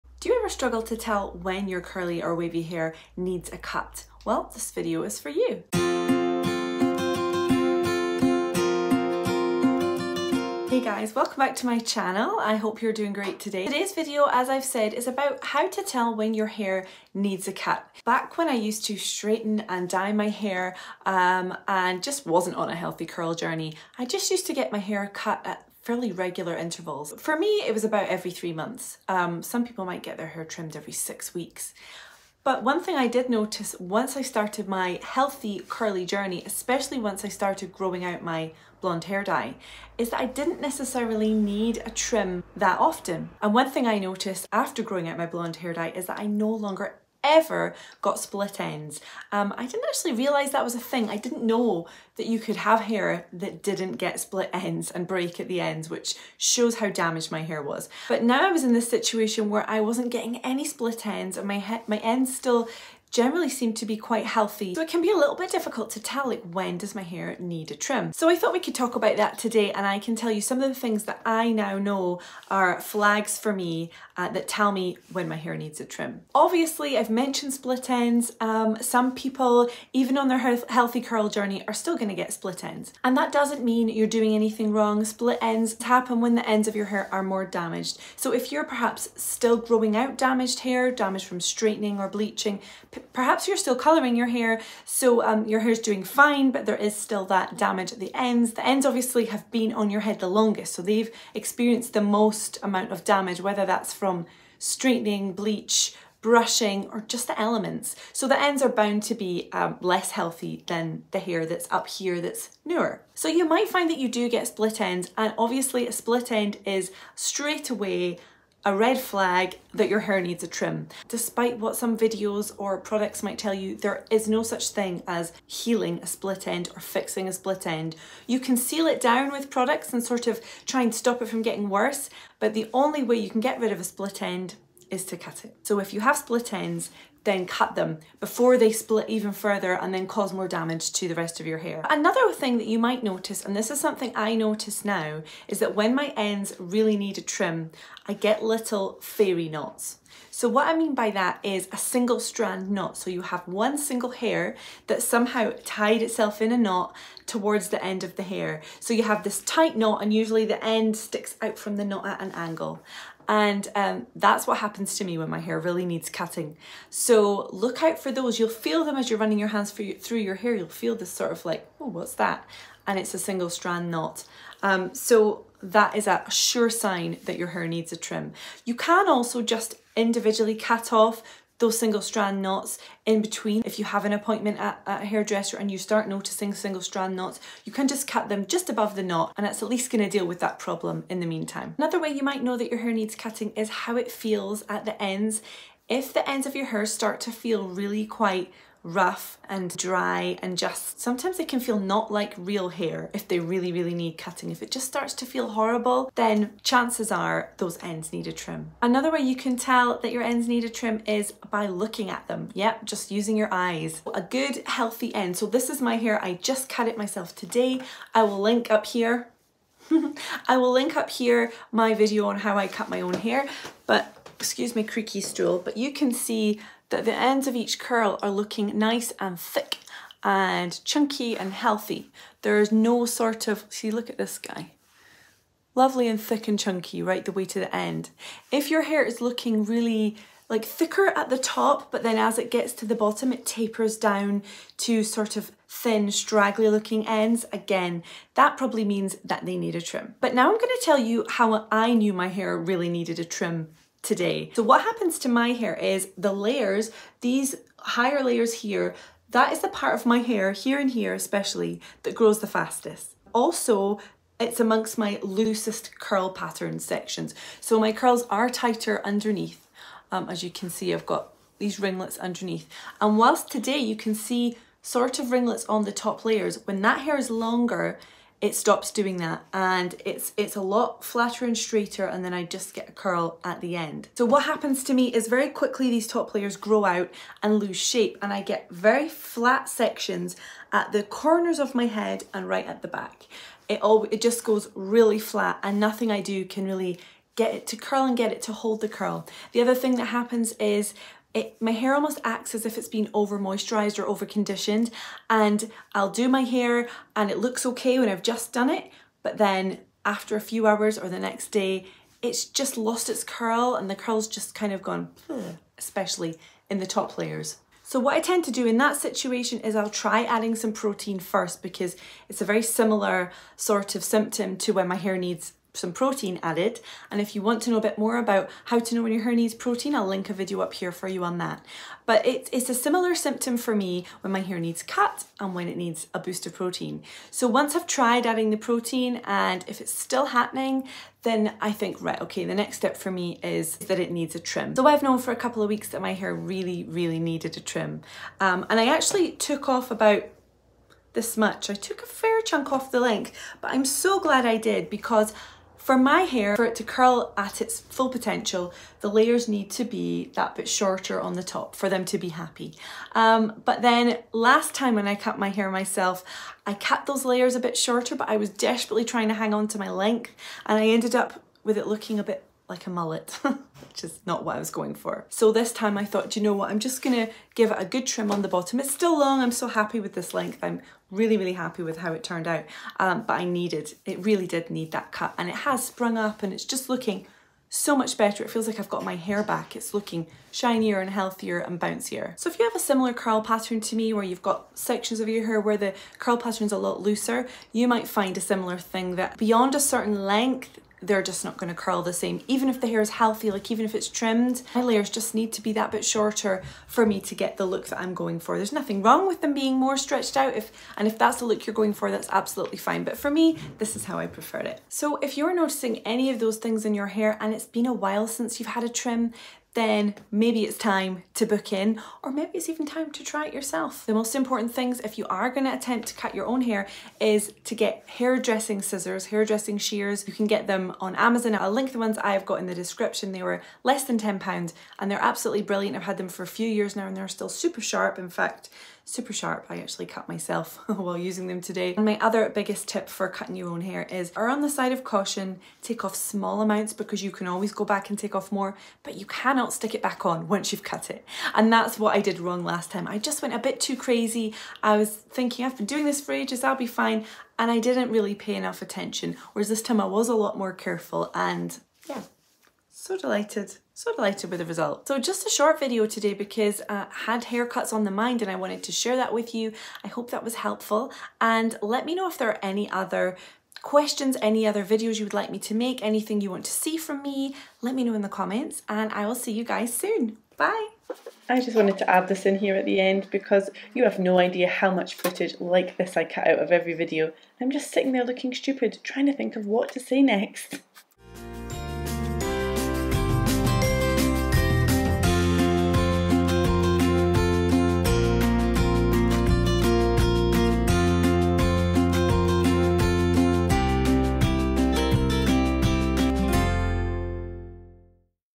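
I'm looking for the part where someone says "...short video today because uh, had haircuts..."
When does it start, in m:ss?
7:45.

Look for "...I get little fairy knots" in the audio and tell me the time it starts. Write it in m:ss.
2:28.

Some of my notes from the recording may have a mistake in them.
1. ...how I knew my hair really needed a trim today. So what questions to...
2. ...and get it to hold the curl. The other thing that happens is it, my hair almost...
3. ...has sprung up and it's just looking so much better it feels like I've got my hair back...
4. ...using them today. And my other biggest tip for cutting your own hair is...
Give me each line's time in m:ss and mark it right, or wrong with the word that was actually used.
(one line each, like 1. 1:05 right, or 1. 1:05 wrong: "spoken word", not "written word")
1. 4:11 wrong: "happens", not "questions"
2. 4:58 right
3. 6:25 right
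4. 7:21 right.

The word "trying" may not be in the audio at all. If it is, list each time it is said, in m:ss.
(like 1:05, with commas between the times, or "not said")
6:09, 8:09.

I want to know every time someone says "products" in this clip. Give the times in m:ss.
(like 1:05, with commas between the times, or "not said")
2:02, 2:09.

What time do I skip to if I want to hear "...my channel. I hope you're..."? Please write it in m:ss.
0:11.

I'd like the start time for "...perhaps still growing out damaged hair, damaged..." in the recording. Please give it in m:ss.
1:28.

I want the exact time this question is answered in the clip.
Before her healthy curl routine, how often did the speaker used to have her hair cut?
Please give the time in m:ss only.
0:27.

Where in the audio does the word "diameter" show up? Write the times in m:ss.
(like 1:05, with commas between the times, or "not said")
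not said.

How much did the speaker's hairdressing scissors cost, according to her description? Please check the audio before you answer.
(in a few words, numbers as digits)
less than £10.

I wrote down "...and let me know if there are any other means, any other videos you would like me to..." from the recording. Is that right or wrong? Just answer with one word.
wrong.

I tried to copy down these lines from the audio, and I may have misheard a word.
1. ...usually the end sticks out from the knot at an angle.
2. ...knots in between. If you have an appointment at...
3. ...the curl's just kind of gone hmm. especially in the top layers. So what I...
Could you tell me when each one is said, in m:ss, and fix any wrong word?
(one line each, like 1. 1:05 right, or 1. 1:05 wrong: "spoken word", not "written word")
1. 2:40 right
2. 3:02 right
3. 5:13 right.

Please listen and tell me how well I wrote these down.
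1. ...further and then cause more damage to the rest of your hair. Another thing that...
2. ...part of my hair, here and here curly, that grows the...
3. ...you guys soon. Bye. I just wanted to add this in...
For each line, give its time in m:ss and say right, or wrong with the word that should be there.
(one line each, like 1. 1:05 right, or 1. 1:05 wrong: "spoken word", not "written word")
1. 2:19 right
2. 4:19 wrong: "especially", not "curly"
3. 7:59 right.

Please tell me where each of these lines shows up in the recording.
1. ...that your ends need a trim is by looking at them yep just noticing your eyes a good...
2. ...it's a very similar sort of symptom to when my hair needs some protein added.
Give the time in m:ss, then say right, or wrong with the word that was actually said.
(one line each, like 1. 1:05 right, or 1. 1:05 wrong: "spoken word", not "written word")
1. 3:29 wrong: "using", not "noticing"
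2. 5:22 right.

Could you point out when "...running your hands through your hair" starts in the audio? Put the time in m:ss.
2:49.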